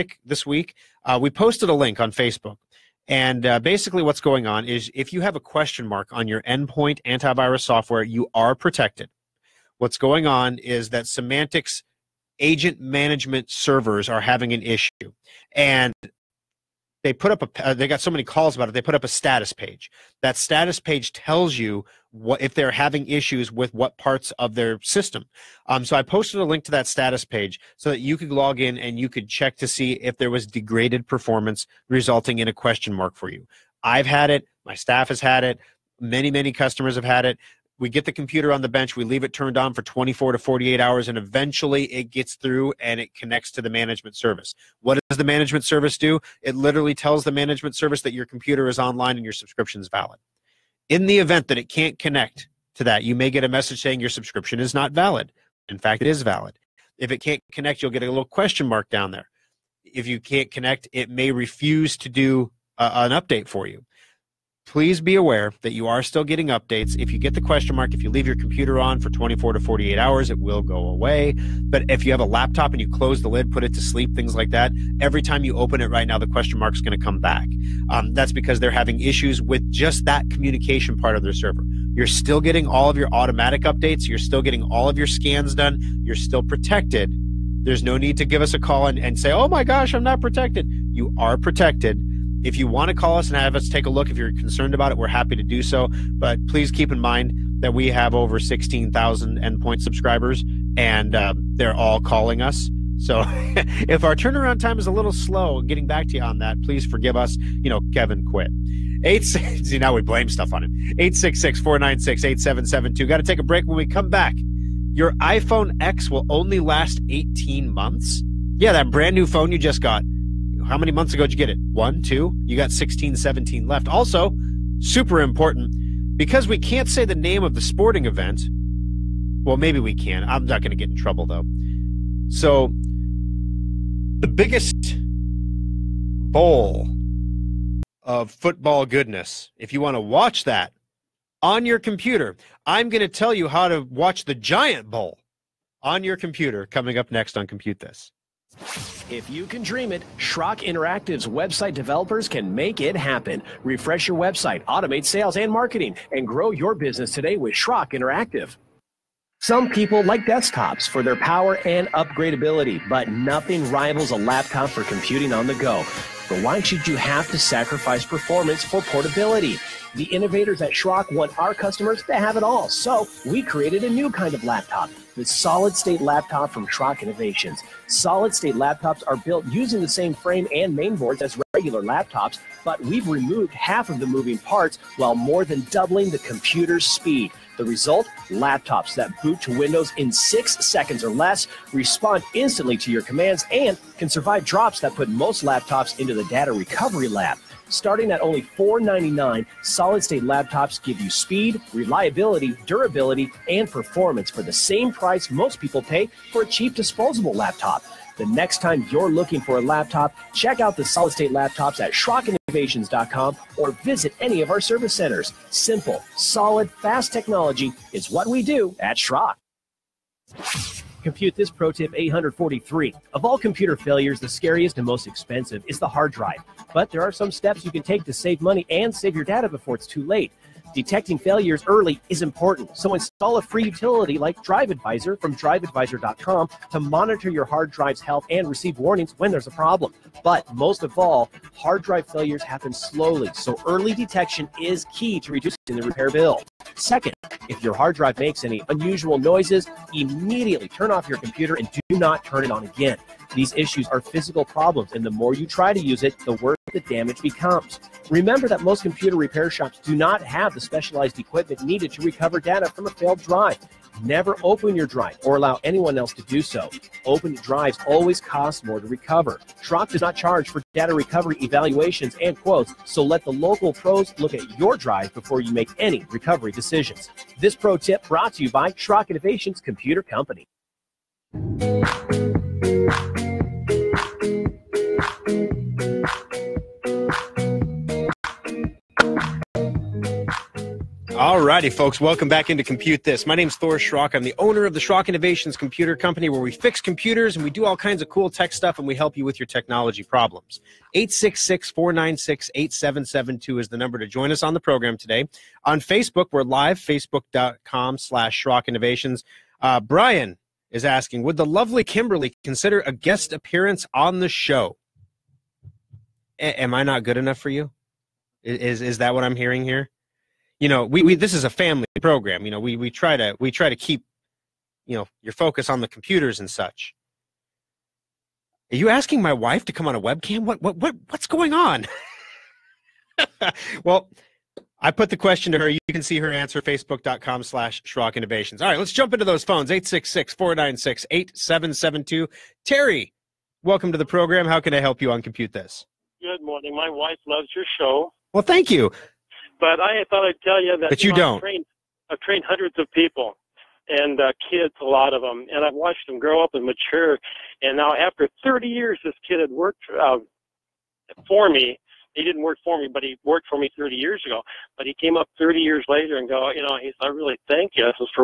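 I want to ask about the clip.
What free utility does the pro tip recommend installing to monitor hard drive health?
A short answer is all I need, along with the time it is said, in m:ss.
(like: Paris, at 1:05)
DriveAdvisor, at 3:54.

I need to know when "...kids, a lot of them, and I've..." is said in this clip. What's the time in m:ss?
5:54.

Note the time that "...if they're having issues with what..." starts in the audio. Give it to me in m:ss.
0:22.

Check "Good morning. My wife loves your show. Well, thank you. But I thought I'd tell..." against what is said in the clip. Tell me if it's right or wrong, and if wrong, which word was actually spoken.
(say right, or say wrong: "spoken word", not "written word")
right.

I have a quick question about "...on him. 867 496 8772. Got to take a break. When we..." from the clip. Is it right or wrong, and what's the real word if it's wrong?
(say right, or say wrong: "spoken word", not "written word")
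wrong: "866", not "867".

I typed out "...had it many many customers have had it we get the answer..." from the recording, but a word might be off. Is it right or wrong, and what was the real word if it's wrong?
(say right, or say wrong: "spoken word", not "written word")
wrong: "computer", not "answer".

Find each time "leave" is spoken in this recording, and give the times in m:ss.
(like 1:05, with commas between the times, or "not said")
0:39, 1:08.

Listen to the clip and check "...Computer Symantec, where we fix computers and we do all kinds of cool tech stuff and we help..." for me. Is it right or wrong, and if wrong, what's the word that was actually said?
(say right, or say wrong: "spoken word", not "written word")
wrong: "Company", not "Symantec".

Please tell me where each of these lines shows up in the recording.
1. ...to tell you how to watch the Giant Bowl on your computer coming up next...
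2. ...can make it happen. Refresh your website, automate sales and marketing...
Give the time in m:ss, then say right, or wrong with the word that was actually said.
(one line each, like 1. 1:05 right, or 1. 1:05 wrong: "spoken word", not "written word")
1. 2:23 right
2. 2:32 right.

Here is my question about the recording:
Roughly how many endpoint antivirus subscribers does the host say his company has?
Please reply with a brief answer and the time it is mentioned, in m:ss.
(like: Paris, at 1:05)
16,000, at 1:38.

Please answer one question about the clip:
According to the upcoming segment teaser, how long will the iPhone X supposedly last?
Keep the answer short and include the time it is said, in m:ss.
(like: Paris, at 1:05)
18 months, at 1:57.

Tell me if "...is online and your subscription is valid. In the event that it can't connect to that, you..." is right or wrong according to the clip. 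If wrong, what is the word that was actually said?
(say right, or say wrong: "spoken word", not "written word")
right.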